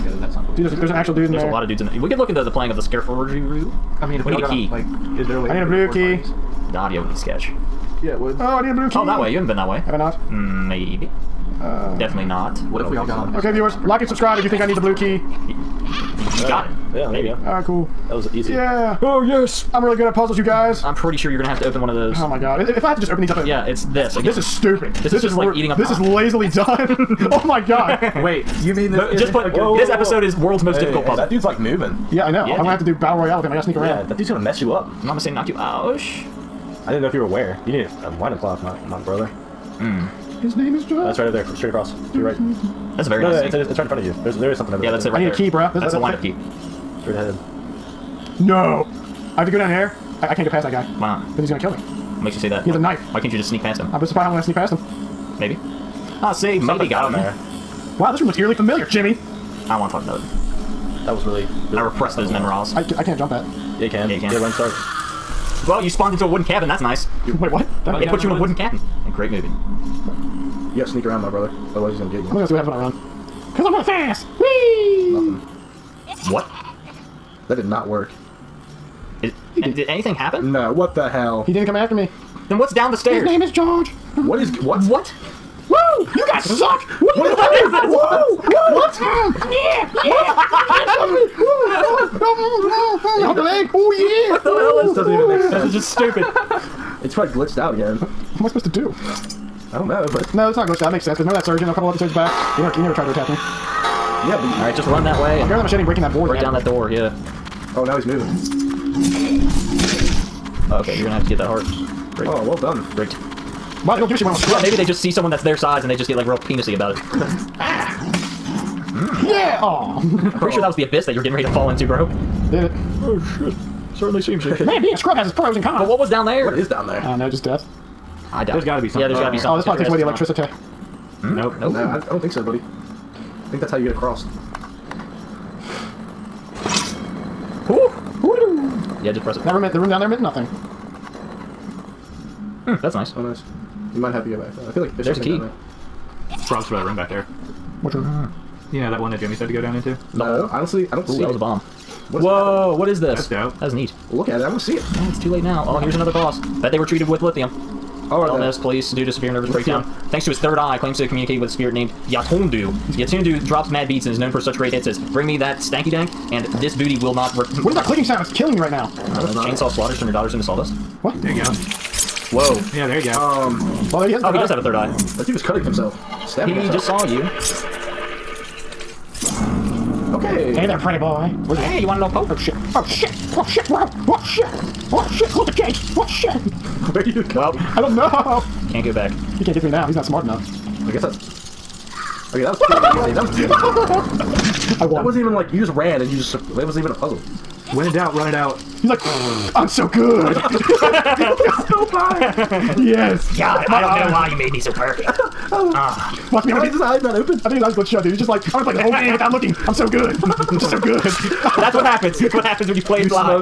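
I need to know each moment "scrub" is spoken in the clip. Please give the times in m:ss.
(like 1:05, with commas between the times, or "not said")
1:54, 2:04.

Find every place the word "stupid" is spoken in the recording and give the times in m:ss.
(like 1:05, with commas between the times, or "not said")
0:24, 1:35.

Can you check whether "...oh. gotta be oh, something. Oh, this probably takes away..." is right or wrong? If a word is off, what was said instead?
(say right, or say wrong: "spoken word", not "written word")
right.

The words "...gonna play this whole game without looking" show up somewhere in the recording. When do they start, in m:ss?
3:28.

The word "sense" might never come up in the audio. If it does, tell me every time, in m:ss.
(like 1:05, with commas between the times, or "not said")
1:35, 1:41.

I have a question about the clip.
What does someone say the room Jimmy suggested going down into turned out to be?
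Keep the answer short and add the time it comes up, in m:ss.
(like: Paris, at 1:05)
a bomb, at 2:31.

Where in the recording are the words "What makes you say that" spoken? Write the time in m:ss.
0:51.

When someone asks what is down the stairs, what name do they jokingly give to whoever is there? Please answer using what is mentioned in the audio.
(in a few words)
George.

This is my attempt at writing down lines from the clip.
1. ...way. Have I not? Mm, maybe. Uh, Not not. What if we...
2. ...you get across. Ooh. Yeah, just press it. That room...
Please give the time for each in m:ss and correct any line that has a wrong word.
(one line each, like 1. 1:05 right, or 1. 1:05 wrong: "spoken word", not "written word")
1. 0:09 wrong: "Definitely", not "Not"
2. 2:13 right.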